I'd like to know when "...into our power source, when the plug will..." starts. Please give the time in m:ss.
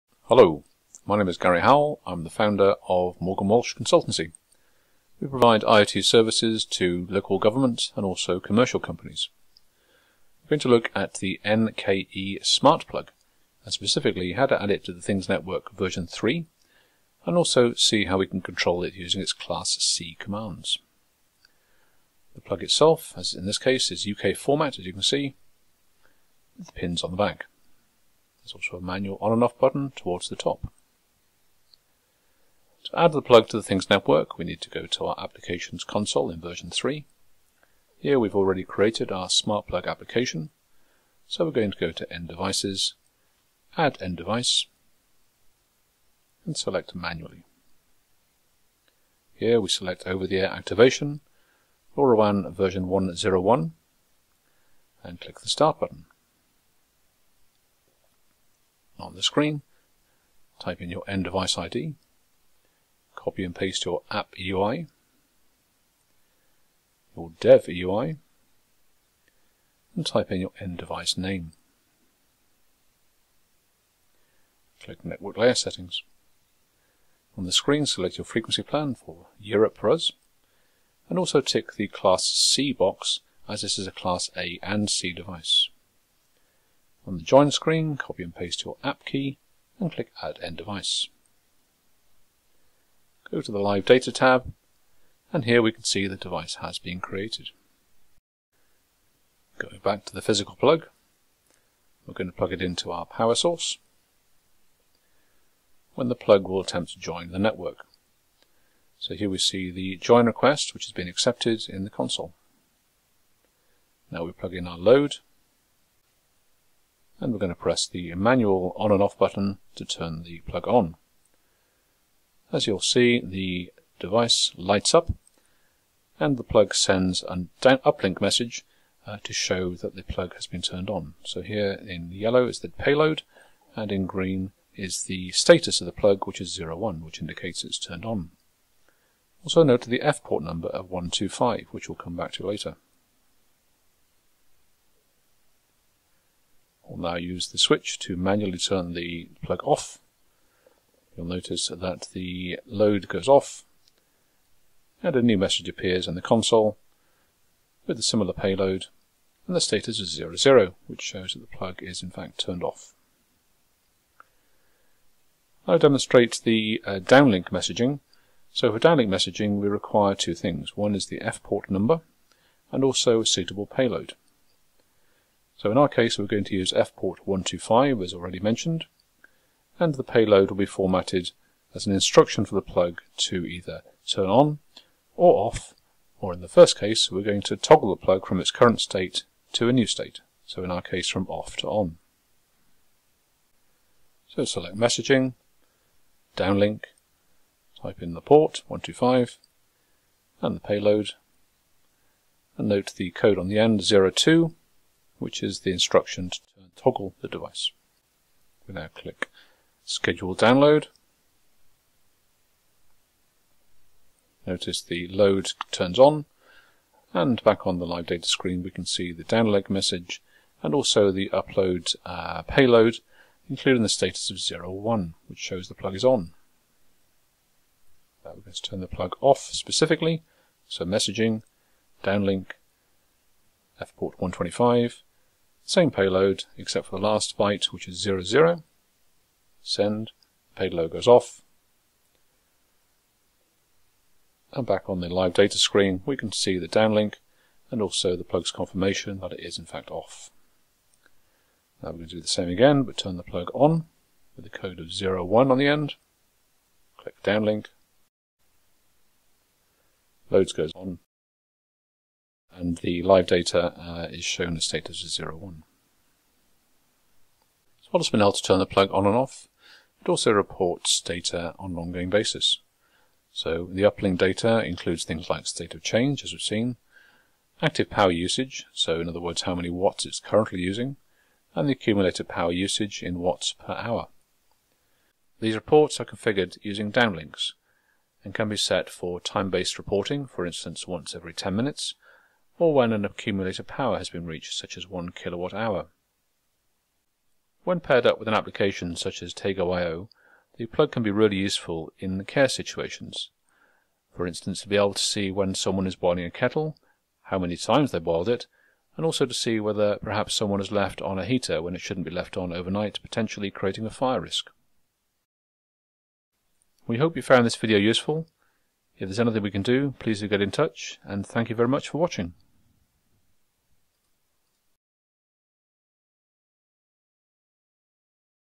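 1:42.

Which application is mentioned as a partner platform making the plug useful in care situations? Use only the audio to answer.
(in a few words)
Tago.io.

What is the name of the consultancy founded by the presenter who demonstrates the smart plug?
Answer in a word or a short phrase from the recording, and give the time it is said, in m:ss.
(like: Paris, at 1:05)
Morgan Walsh Consultancy, at 0:03.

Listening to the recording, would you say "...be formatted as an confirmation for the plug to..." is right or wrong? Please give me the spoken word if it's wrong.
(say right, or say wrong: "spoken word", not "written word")
wrong: "instruction", not "confirmation".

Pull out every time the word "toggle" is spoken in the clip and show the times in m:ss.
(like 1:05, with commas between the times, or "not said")
3:07, 3:26.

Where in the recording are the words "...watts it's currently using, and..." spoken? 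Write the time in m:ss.
4:39.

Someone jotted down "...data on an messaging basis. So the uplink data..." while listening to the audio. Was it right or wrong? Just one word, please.
wrong.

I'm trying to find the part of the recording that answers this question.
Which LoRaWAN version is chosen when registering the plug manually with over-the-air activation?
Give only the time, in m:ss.
0:51.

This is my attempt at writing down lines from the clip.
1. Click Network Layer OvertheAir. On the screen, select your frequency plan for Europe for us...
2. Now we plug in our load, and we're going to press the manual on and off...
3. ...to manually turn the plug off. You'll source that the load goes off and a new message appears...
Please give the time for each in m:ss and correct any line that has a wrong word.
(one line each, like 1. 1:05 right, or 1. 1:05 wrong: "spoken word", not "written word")
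1. 1:14 wrong: "Settings", not "OvertheAir"
2. 1:54 right
3. 2:27 wrong: "notice", not "source".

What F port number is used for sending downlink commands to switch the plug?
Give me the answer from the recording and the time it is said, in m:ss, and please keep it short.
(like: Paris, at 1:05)
125, at 2:56.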